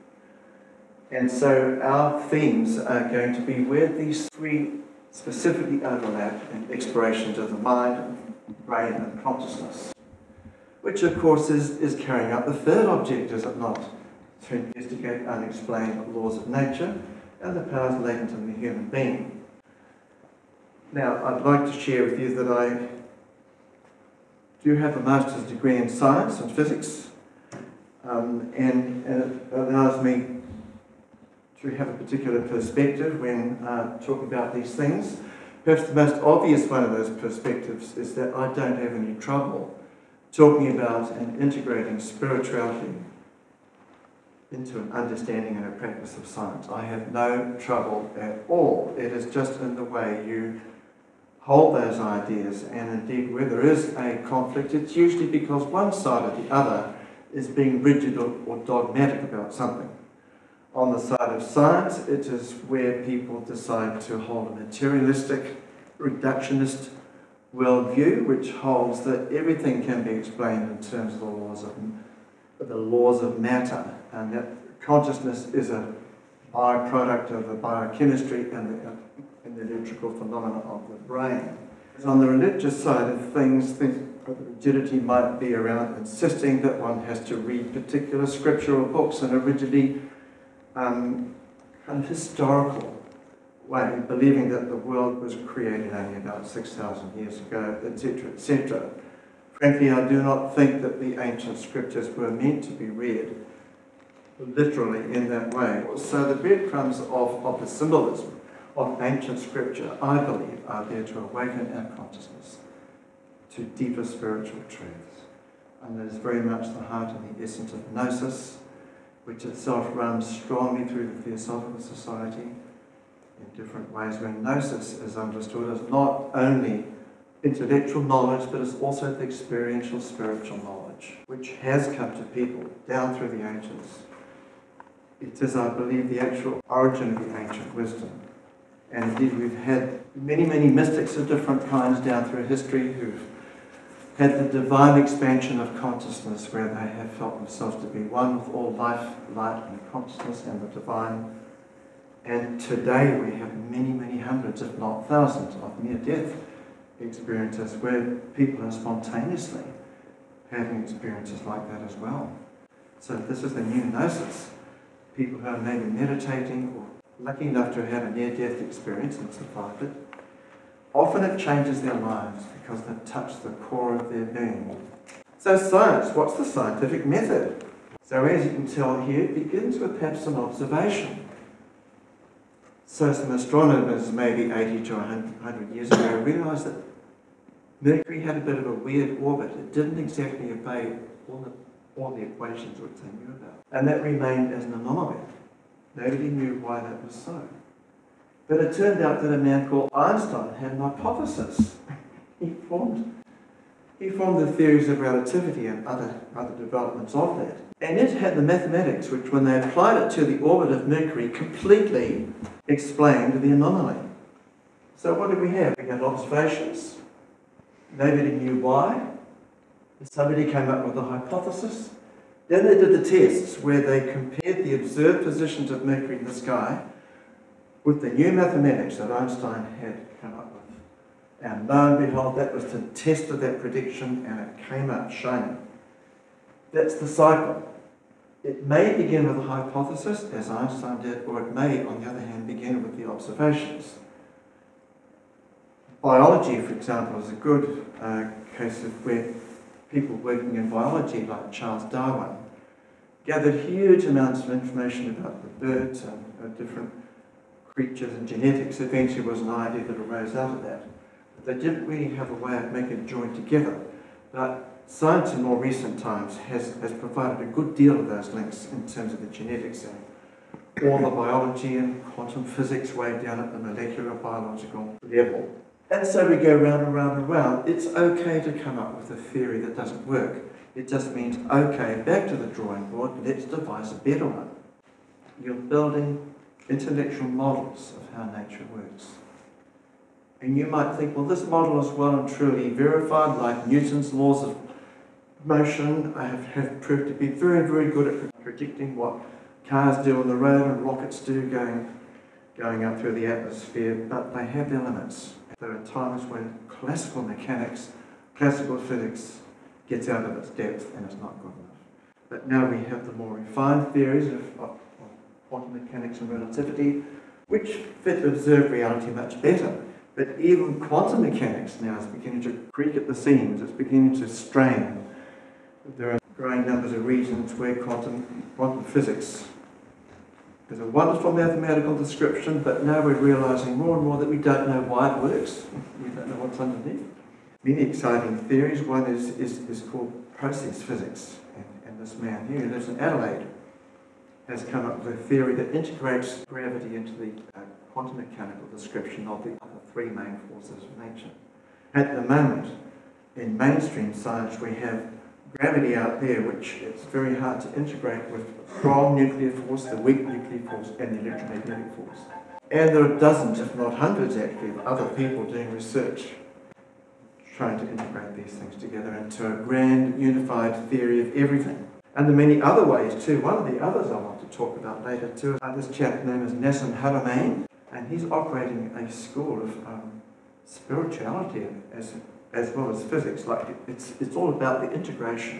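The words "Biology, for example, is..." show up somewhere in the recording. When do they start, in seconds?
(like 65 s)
245 s.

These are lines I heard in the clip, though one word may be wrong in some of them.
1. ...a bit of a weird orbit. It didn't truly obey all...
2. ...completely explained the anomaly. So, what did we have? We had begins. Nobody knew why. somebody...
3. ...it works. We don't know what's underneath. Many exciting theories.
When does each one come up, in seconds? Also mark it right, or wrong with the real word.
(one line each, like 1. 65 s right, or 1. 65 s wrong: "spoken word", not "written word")
1. 188 s wrong: "exactly", not "truly"
2. 211 s wrong: "observations", not "begins"
3. 335 s right.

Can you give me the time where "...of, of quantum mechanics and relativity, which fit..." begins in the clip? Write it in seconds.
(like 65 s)
314 s.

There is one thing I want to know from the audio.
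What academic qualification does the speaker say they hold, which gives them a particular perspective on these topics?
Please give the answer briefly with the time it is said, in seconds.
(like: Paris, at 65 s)
master's degree in science and physics, at 24 s.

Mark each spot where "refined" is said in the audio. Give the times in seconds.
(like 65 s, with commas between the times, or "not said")
313 s.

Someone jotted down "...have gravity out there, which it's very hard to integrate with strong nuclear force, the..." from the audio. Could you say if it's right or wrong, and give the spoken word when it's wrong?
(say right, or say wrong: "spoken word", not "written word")
right.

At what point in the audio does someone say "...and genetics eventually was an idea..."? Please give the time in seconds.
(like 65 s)
258 s.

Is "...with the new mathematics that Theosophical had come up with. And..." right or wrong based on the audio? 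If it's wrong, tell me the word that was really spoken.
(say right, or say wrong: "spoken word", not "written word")
wrong: "Einstein", not "Theosophical".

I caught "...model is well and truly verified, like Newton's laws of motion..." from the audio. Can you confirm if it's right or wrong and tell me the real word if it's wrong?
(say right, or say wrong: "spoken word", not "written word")
right.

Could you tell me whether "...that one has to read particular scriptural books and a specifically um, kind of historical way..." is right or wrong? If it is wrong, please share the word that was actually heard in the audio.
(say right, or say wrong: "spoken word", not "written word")
wrong: "rigidly", not "specifically".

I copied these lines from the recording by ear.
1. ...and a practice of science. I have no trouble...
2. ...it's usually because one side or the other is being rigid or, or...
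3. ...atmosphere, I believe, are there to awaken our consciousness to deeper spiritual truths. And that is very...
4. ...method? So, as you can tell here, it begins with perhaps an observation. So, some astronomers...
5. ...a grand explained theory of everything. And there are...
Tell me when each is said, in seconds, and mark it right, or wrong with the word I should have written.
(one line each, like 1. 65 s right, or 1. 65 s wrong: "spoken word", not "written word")
1. 45 s right
2. 54 s right
3. 109 s wrong: "scripture", not "atmosphere"
4. 177 s right
5. 369 s wrong: "unified", not "explained".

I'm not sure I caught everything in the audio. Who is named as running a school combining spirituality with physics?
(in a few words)
Nassim Haramein.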